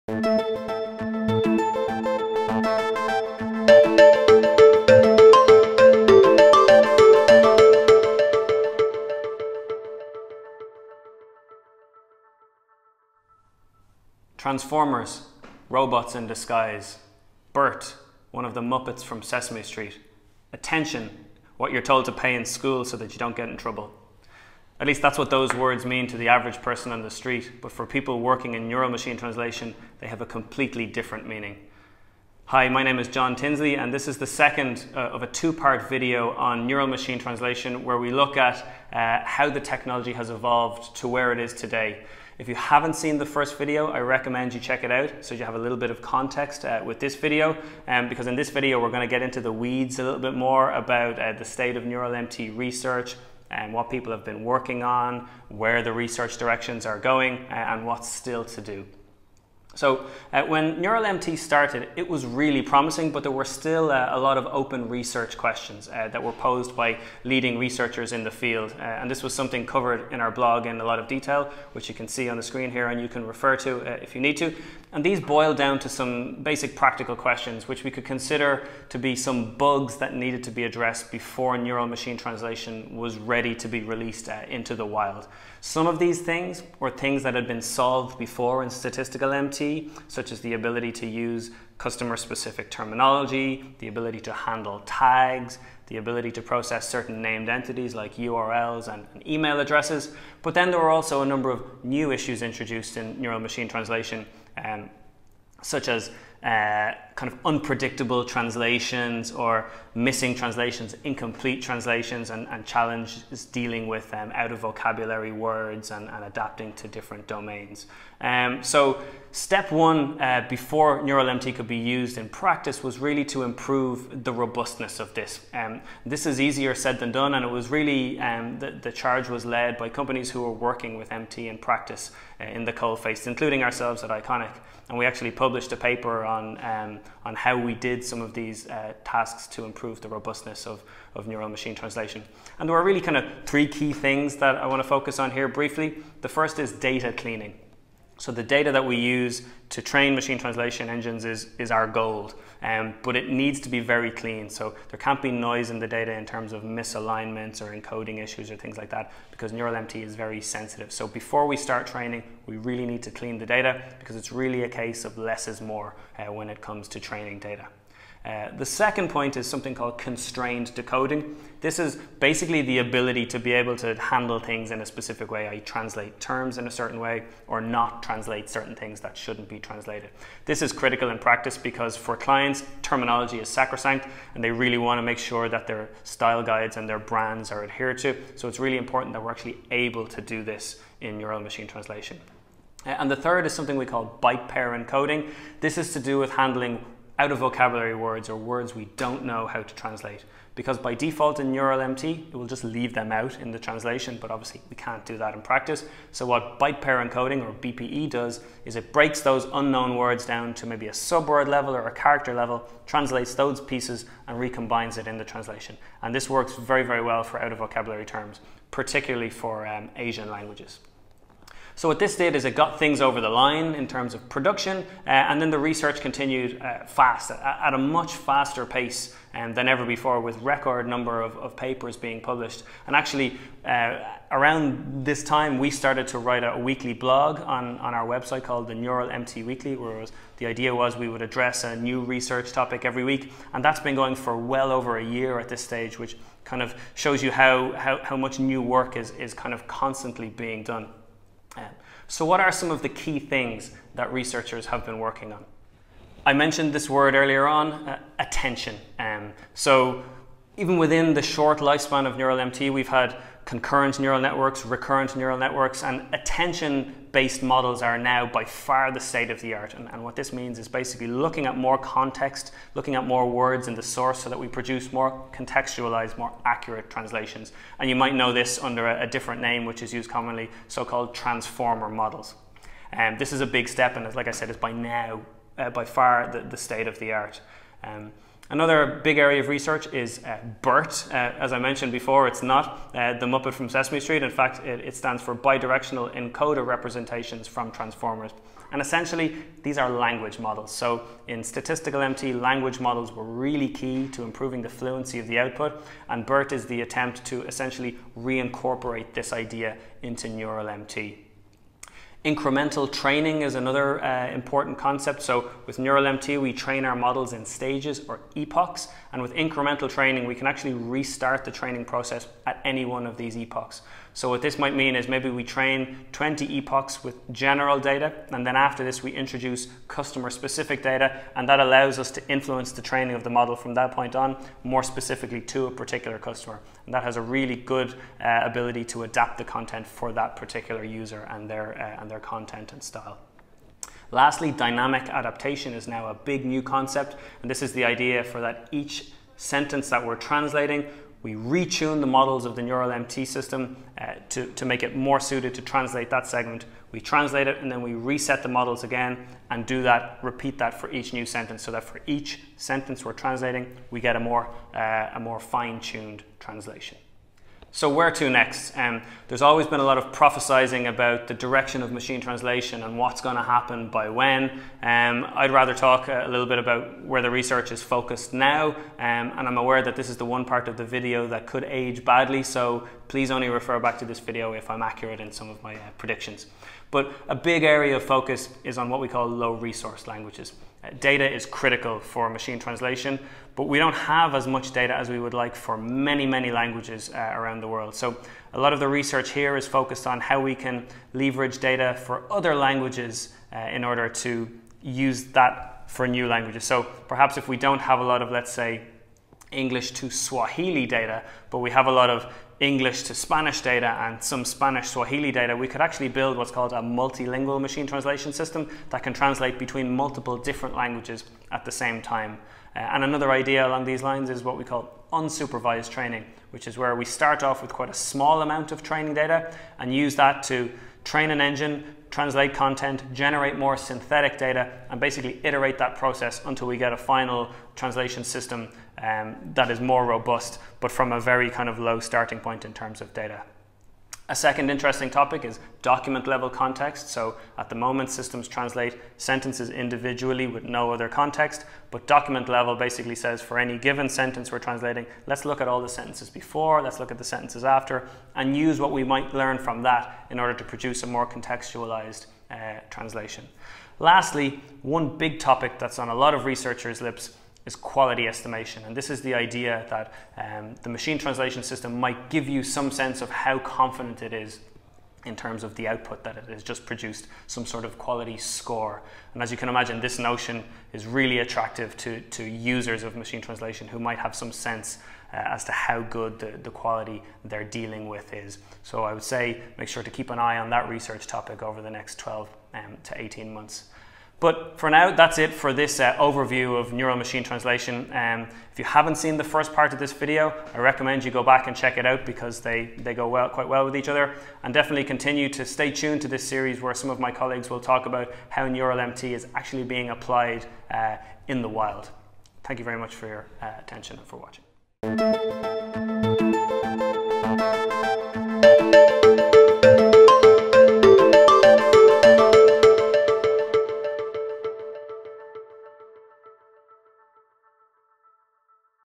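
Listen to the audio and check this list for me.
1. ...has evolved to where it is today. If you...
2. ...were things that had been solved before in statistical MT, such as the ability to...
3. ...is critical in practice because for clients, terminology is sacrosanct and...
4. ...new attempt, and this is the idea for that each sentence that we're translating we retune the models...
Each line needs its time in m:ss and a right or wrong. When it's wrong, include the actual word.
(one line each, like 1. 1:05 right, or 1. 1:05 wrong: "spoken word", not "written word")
1. 0:40 right
2. 1:26 right
3. 3:00 right
4. 5:46 wrong: "concept", not "attempt".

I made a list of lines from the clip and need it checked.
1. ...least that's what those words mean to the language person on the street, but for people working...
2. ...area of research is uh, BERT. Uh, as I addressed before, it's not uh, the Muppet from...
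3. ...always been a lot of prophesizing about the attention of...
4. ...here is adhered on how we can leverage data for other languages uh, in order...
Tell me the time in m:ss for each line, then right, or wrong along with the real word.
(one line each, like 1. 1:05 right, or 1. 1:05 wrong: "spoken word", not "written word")
1. 0:24 wrong: "average", not "language"
2. 4:49 wrong: "mentioned", not "addressed"
3. 6:09 wrong: "direction", not "attention"
4. 6:39 wrong: "focused", not "adhered".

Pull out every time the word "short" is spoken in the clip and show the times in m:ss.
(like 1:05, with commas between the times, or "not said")
4:21.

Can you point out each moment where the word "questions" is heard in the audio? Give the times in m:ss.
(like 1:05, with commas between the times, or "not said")
1:05, 1:17.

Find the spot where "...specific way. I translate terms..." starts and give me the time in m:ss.
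2:54.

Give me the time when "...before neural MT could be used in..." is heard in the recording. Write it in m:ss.
2:00.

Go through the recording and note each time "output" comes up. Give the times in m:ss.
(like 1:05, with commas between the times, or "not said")
5:05, 7:55.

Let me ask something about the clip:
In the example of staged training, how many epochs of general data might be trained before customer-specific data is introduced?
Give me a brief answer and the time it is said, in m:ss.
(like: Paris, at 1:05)
20, at 5:26.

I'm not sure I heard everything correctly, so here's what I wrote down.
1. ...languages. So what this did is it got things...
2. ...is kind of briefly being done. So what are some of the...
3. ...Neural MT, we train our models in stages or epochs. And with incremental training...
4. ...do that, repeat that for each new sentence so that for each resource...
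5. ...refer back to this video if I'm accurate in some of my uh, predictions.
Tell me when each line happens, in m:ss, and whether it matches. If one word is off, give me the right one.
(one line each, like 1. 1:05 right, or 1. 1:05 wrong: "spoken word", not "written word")
1. 3:40 right
2. 4:09 wrong: "constantly", not "briefly"
3. 5:15 right
4. 5:59 wrong: "sentence", not "resource"
5. 6:23 right.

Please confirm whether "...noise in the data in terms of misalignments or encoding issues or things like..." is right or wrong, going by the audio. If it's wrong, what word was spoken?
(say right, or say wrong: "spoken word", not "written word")
right.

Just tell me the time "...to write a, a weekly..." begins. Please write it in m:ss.
3:56.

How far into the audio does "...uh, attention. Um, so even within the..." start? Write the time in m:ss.
4:17.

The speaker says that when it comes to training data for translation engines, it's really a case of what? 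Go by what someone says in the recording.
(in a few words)
less is more.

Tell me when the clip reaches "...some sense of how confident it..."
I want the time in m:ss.
7:52.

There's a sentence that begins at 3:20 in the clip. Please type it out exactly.
Because by default in NeuralMT, it will just leave them out in the translation, but obviously we can't do that in practice.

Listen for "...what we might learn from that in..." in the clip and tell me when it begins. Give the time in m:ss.
7:38.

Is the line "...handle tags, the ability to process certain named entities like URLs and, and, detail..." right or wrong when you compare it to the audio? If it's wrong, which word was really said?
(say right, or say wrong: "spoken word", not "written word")
wrong: "email", not "detail".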